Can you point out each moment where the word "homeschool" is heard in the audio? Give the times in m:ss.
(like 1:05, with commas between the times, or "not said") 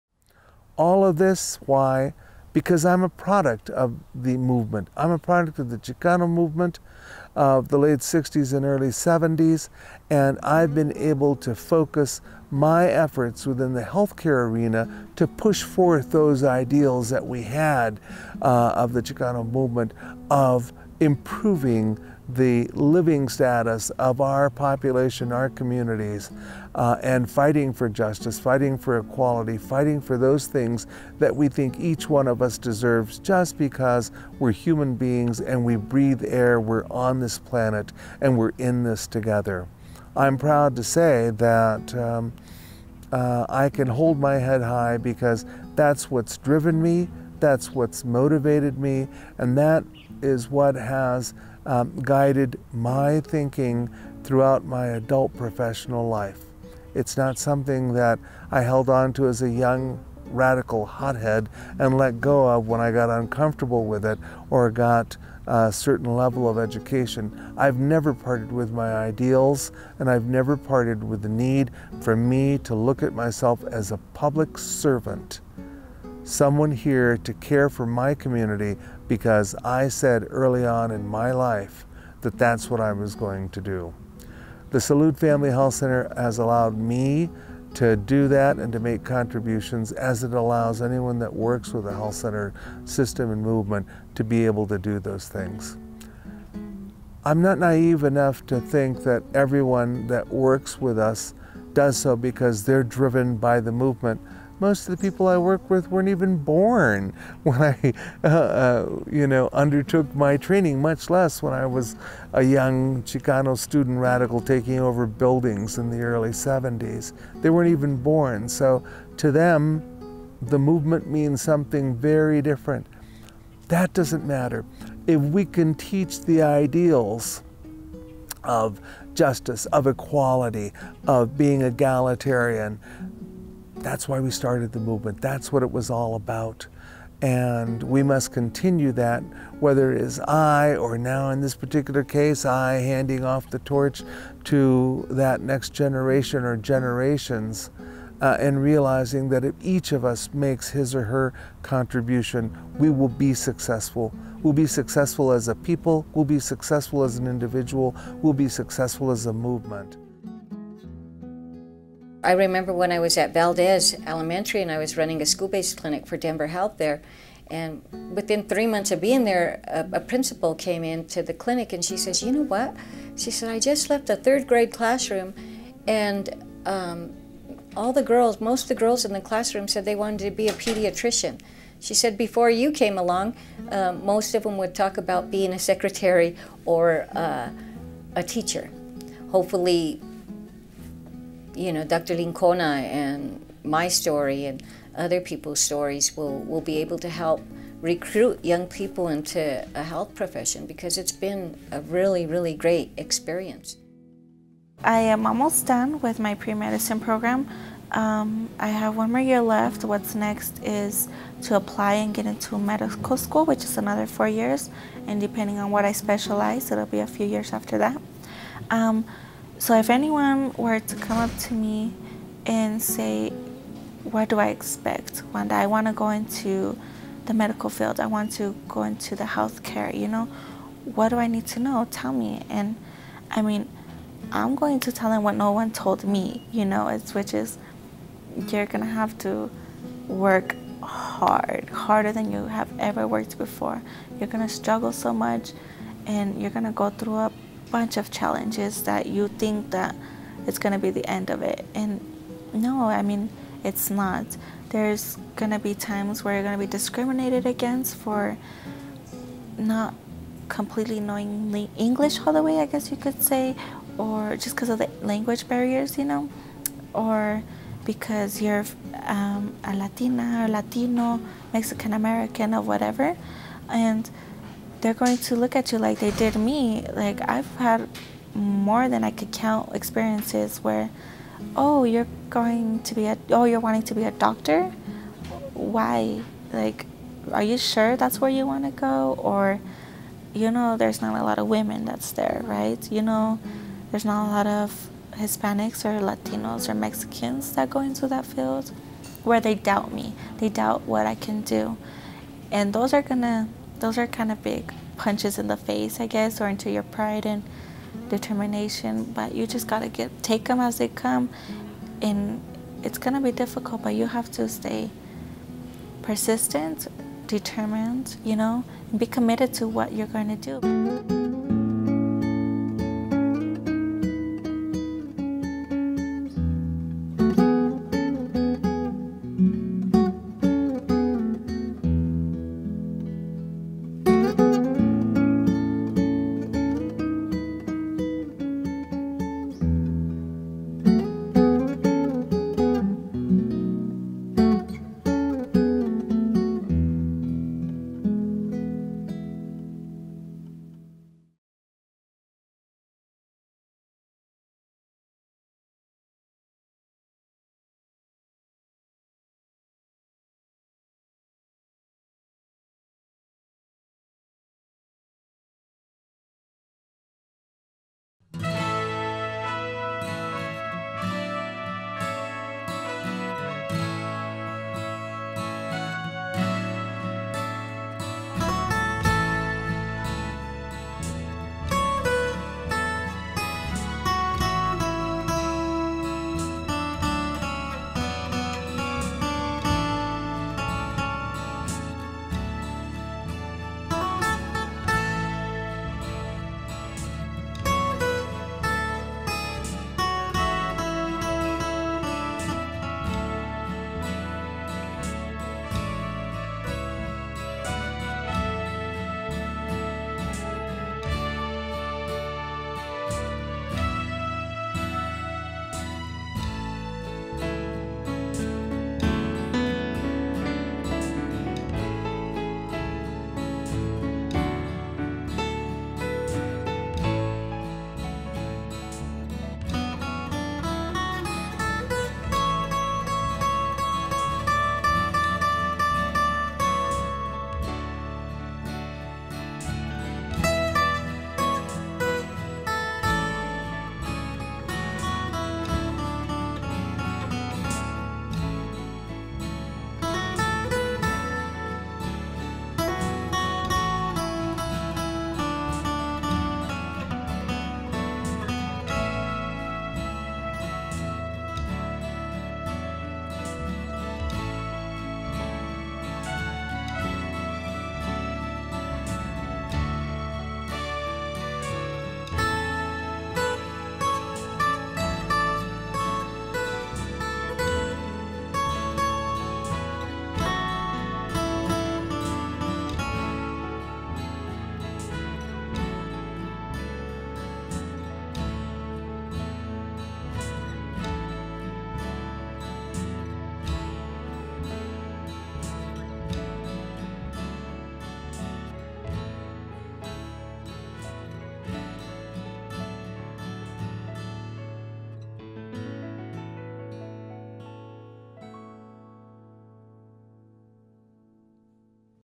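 not said.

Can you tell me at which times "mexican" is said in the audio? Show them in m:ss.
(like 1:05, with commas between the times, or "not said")
4:31, 4:56.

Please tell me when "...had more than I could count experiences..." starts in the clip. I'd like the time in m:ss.
4:37.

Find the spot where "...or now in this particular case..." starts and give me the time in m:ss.
2:20.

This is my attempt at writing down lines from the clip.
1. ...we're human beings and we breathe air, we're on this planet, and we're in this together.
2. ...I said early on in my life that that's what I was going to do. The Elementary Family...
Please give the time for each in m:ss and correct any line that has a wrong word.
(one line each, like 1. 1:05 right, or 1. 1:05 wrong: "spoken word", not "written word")
1. 0:34 right
2. 1:19 wrong: "Salud", not "Elementary".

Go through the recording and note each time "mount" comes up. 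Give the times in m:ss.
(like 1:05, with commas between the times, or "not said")
not said.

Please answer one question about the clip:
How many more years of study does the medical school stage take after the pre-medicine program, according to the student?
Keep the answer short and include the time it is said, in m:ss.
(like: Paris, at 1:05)
4 years, at 3:34.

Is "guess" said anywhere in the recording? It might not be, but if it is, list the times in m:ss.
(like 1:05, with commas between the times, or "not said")
4:22, 5:06.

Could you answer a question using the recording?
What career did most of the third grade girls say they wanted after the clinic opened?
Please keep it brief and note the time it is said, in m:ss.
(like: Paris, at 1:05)
pediatrician, at 3:00.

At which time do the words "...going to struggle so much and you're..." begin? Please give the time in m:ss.
4:04.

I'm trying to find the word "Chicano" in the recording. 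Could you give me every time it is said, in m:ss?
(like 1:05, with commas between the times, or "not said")
0:05, 0:19, 1:53.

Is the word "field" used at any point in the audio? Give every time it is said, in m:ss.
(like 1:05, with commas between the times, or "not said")
3:47, 4:58.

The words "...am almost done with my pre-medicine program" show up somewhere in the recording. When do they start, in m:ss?
3:25.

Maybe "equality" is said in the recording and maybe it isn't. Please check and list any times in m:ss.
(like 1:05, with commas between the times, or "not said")
0:28, 2:09.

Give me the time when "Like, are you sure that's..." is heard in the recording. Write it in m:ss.
4:46.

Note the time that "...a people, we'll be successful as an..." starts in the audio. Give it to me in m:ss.
2:35.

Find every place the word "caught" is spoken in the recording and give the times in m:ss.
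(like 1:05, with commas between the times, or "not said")
not said.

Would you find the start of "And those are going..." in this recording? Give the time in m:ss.
5:02.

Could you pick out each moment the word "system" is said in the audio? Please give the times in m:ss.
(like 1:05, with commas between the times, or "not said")
1:32.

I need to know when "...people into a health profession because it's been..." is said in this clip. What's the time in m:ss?
3:18.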